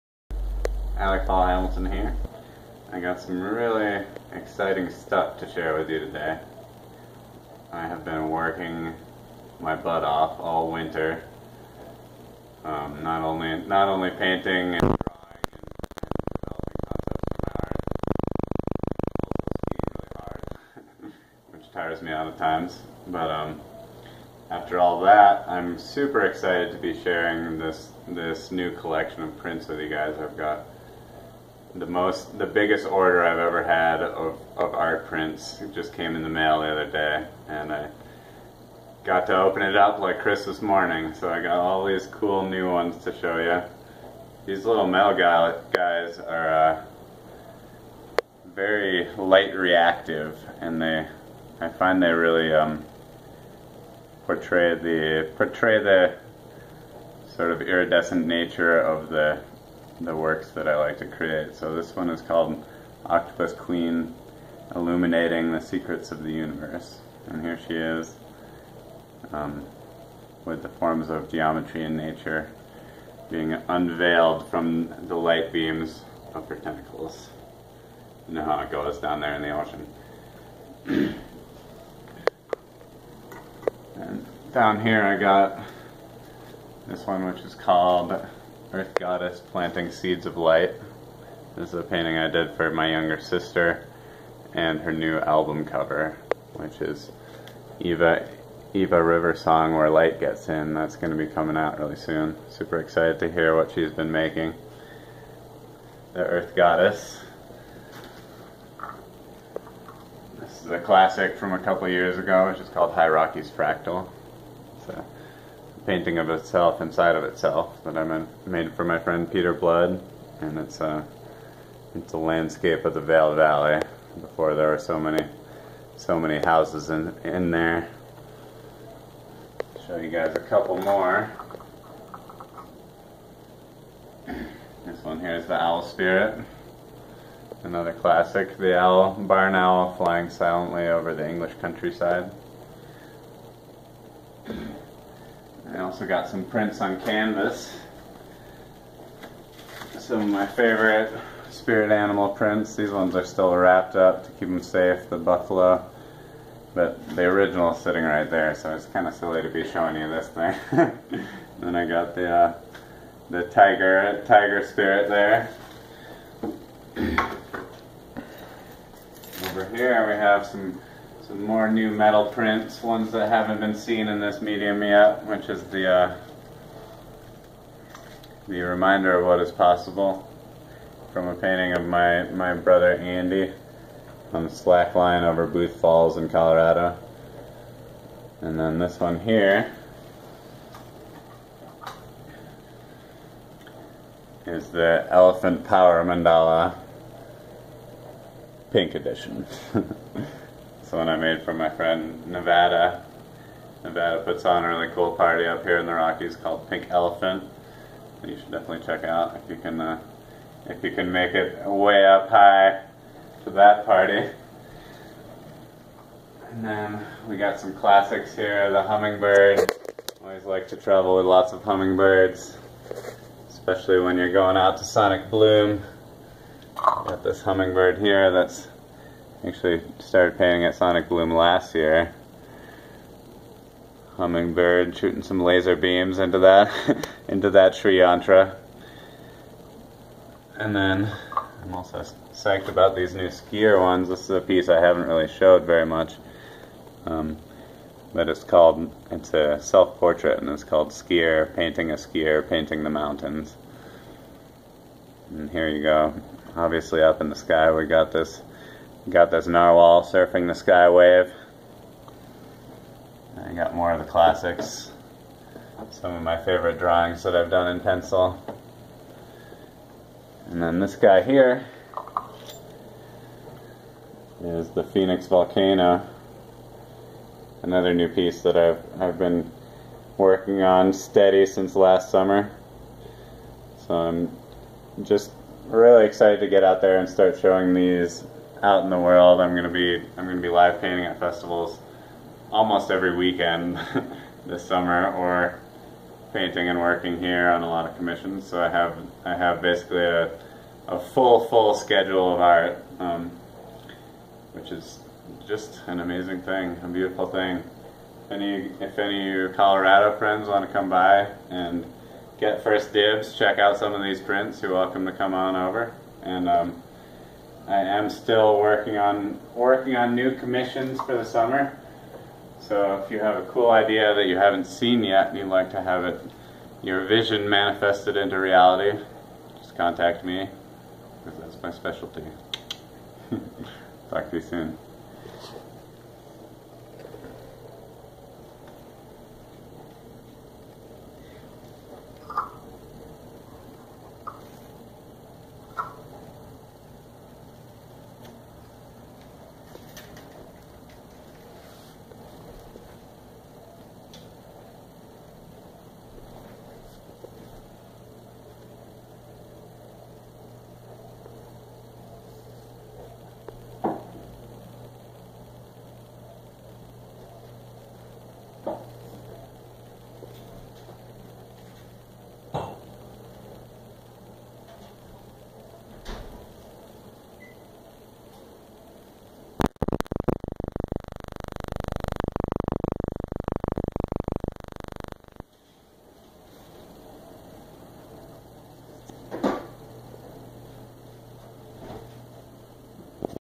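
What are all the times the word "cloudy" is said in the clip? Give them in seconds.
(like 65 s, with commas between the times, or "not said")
not said.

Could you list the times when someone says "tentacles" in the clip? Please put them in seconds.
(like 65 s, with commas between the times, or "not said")
76 s.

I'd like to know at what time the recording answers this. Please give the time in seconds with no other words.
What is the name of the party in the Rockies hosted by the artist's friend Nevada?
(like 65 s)
206 s.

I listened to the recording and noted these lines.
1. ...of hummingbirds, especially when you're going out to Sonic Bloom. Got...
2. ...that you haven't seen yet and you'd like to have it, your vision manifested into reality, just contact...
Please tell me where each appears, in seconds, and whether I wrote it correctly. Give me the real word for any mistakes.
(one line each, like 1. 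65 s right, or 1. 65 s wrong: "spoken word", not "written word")
1. 221 s right
2. 324 s right.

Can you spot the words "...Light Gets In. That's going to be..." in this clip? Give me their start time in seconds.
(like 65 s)
99 s.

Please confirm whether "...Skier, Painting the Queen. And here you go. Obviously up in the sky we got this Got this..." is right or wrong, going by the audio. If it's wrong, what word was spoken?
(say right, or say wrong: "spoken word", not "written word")
wrong: "Mountains", not "Queen".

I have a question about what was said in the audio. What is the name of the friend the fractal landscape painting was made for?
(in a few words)
Peter Blood.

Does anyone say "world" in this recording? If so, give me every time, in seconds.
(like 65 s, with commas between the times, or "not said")
288 s.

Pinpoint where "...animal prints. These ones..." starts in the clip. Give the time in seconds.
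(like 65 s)
151 s.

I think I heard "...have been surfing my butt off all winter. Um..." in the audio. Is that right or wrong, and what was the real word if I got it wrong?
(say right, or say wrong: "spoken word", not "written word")
wrong: "working", not "surfing".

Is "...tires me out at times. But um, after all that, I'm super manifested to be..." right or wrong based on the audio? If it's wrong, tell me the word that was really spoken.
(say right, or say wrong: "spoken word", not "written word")
wrong: "excited", not "manifested".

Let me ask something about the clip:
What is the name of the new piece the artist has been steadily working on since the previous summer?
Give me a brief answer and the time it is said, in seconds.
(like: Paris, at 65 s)
Phoenix Volcano, at 274 s.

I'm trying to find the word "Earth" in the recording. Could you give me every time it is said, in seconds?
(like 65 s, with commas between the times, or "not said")
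88 s, 106 s.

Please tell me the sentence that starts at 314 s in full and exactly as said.
You're welcome to come on over and.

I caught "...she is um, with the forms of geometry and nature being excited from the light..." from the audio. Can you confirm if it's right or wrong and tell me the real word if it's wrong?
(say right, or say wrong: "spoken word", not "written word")
wrong: "unveiled", not "excited".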